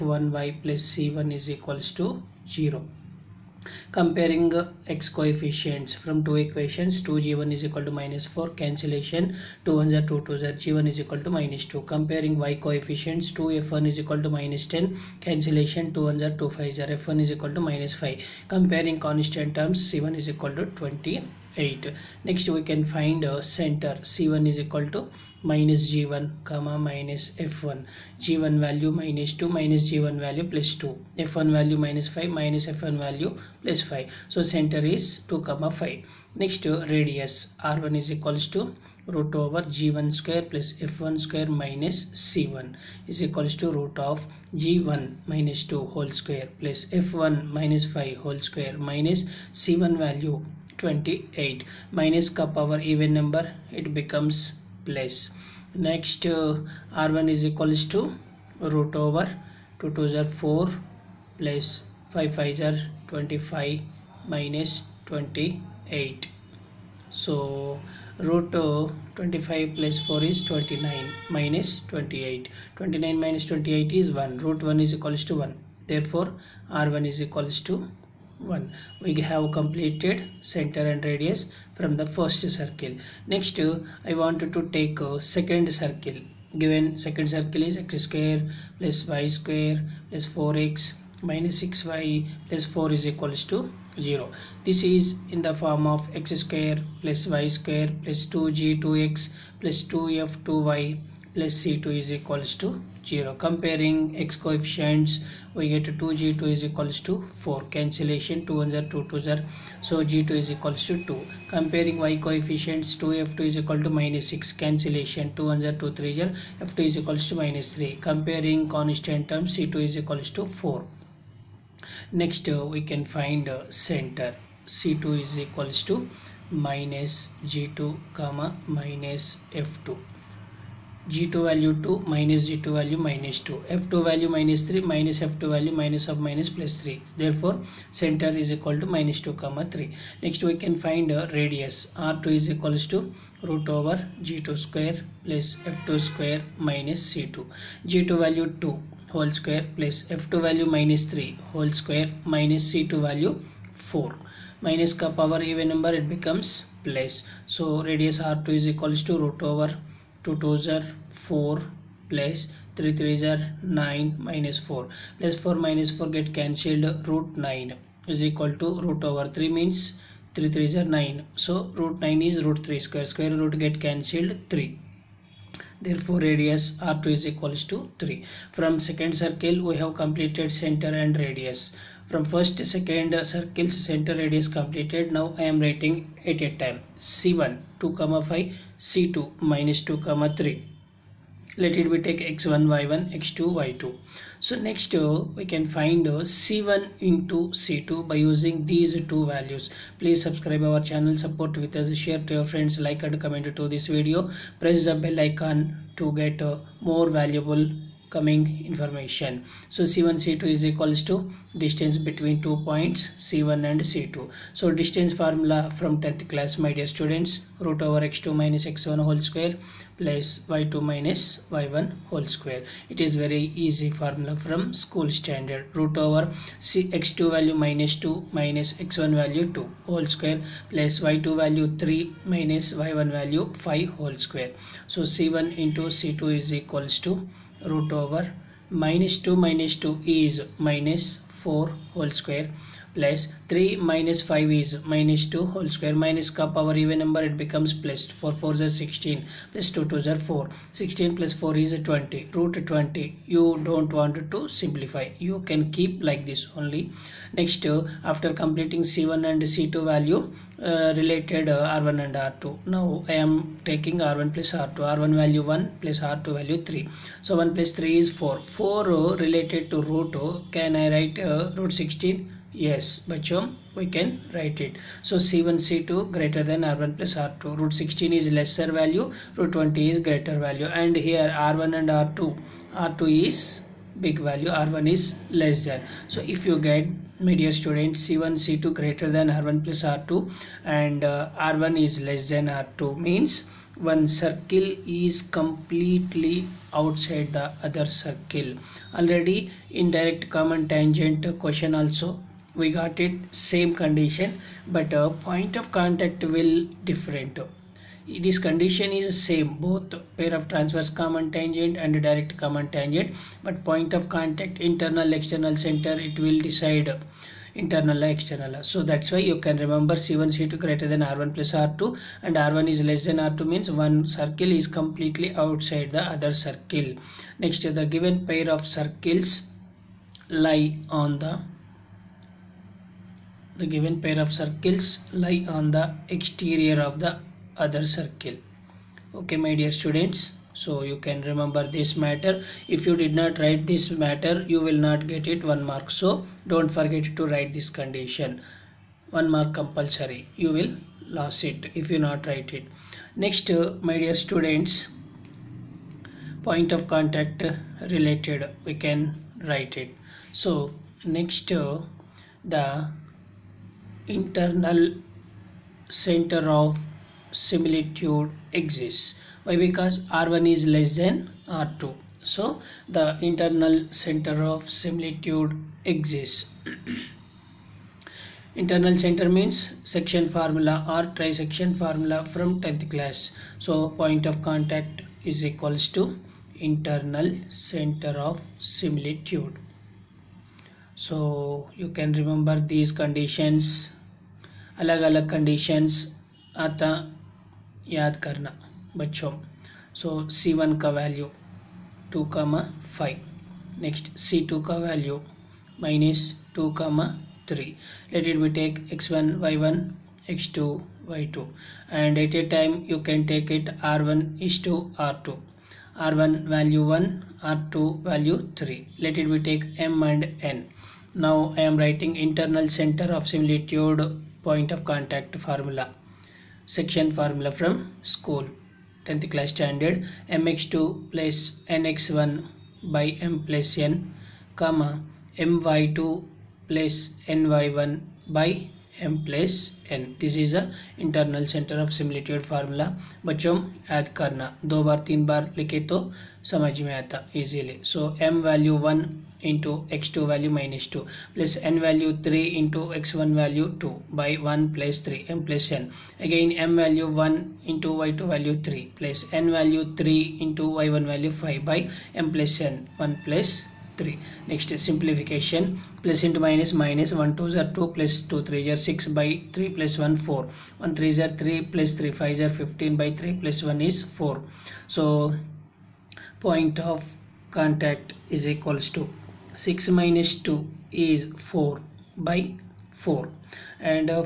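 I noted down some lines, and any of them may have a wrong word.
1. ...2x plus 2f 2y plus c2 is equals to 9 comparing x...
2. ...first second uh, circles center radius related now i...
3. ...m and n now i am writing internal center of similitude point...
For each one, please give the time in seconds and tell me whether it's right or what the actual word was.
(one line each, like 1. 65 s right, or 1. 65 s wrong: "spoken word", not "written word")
1. 98 s wrong: "0", not "9"
2. 182 s wrong: "completed", not "related"
3. 419 s right.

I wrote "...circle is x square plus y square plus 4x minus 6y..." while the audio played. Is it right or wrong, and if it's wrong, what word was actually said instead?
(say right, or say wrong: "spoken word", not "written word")
right.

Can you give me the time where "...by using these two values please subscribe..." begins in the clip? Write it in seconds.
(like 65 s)
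198 s.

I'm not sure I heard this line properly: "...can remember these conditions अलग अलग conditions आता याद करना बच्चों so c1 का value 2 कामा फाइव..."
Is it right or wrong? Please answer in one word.
right.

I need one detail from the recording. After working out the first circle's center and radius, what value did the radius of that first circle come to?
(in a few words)
1.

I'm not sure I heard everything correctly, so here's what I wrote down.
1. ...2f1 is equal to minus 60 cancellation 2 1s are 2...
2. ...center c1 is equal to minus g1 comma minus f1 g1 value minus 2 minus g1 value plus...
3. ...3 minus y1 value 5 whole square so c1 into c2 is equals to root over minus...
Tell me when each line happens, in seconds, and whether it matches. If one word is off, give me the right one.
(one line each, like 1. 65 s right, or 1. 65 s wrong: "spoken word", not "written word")
1. 13 s wrong: "10", not "60"
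2. 23 s right
3. 231 s right.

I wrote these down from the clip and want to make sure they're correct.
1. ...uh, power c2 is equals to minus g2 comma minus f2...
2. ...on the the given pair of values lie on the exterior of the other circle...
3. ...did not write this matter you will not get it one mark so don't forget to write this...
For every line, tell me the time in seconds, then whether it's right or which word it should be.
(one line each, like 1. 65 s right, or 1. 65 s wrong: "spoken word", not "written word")
1. 123 s wrong: "center", not "power"
2. 330 s wrong: "circles", not "values"
3. 343 s right.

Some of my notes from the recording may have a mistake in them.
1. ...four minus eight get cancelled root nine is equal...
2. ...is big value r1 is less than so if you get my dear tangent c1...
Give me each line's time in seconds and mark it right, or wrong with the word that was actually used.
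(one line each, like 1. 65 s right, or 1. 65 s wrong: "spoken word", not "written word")
1. 165 s wrong: "four", not "eight"
2. 283 s wrong: "student", not "tangent".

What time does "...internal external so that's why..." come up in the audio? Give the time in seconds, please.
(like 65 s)
317 s.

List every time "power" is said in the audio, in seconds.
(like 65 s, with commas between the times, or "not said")
52 s, 155 s, 246 s.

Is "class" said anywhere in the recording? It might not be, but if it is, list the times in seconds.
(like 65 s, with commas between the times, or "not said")
216 s, 382 s, 429 s.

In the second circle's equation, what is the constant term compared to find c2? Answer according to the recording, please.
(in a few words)
4.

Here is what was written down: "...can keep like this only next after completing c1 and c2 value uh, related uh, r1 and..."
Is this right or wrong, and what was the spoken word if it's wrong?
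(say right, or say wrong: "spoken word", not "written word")
right.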